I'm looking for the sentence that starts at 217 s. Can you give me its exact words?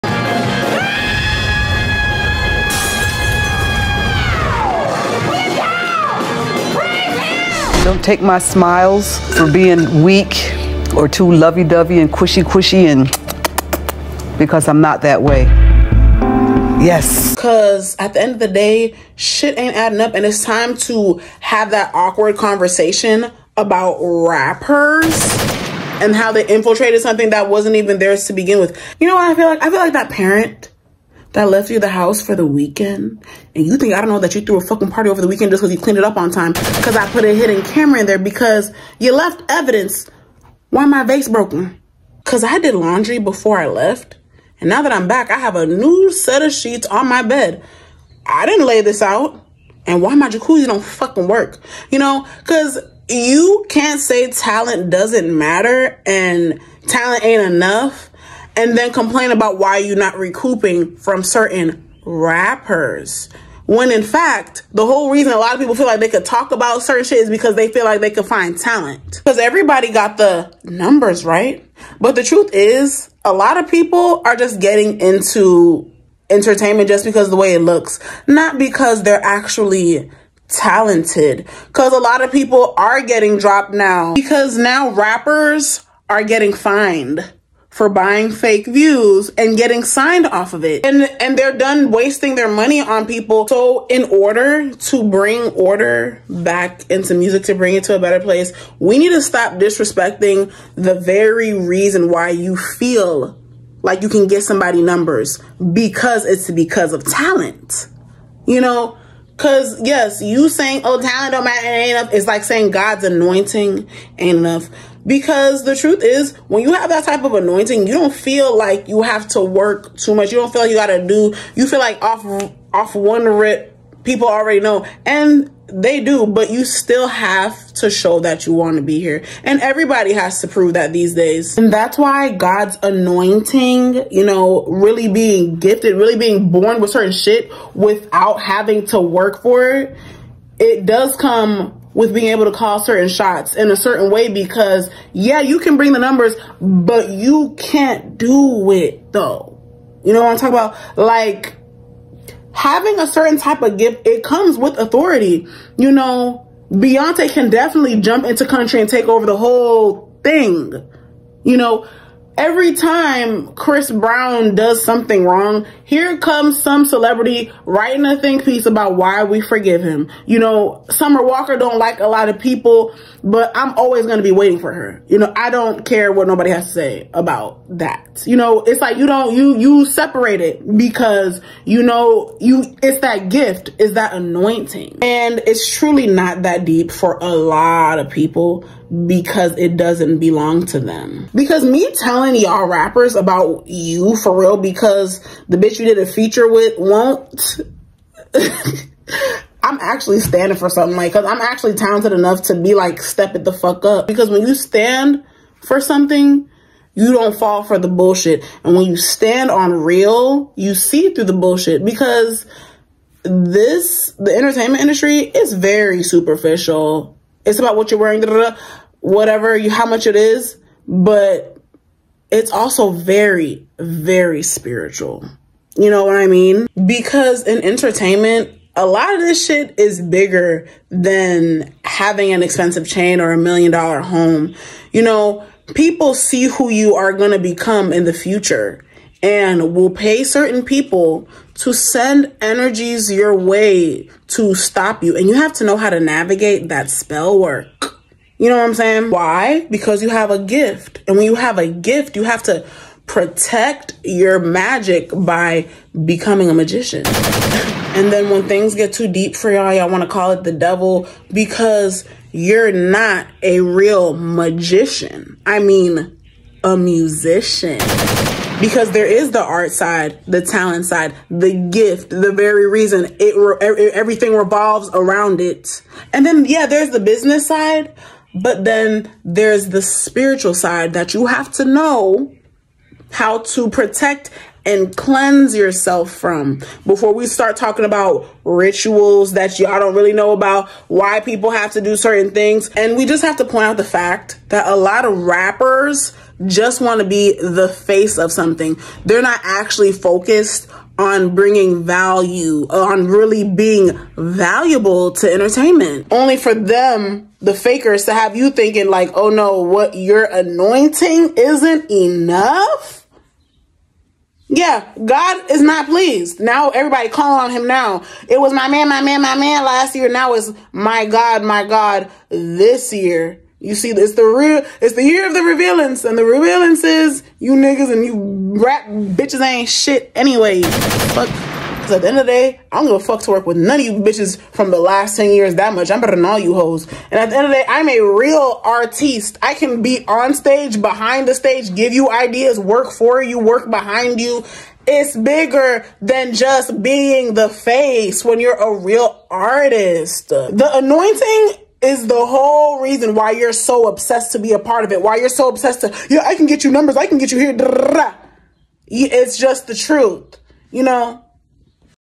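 It's about what you're wearing, whatever you, how much it is, but it's also very, very spiritual.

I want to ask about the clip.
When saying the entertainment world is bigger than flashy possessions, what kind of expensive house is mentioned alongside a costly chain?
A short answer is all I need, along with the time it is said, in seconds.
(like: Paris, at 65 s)
million dollar home, at 233 s.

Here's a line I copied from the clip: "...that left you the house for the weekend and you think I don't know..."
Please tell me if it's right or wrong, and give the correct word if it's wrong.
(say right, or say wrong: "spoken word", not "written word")
right.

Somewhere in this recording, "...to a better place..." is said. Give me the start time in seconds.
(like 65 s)
97 s.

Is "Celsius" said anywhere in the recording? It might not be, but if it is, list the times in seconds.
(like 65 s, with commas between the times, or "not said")
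not said.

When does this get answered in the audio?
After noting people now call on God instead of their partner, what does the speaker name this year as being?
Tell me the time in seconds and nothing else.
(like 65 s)
325 s.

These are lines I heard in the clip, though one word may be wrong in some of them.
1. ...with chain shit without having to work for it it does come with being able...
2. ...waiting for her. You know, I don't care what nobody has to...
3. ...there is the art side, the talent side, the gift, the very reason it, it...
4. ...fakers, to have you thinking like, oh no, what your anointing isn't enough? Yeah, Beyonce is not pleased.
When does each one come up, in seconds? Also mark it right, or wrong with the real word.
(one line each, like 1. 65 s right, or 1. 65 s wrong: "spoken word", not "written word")
1. 136 s wrong: "certain", not "chain"
2. 174 s right
3. 268 s right
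4. 307 s wrong: "God", not "Beyonce".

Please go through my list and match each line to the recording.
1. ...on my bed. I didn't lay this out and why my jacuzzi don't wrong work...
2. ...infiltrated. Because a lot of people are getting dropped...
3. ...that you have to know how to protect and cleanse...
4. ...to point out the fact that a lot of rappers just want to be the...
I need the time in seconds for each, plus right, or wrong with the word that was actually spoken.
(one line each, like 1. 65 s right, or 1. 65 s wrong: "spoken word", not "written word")
1. 46 s wrong: "fucking", not "wrong"
2. 80 s wrong: "talented", not "infiltrated"
3. 280 s right
4. 293 s right.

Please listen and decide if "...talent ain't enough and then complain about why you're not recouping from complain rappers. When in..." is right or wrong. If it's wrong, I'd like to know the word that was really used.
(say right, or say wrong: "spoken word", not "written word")
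wrong: "certain", not "complain".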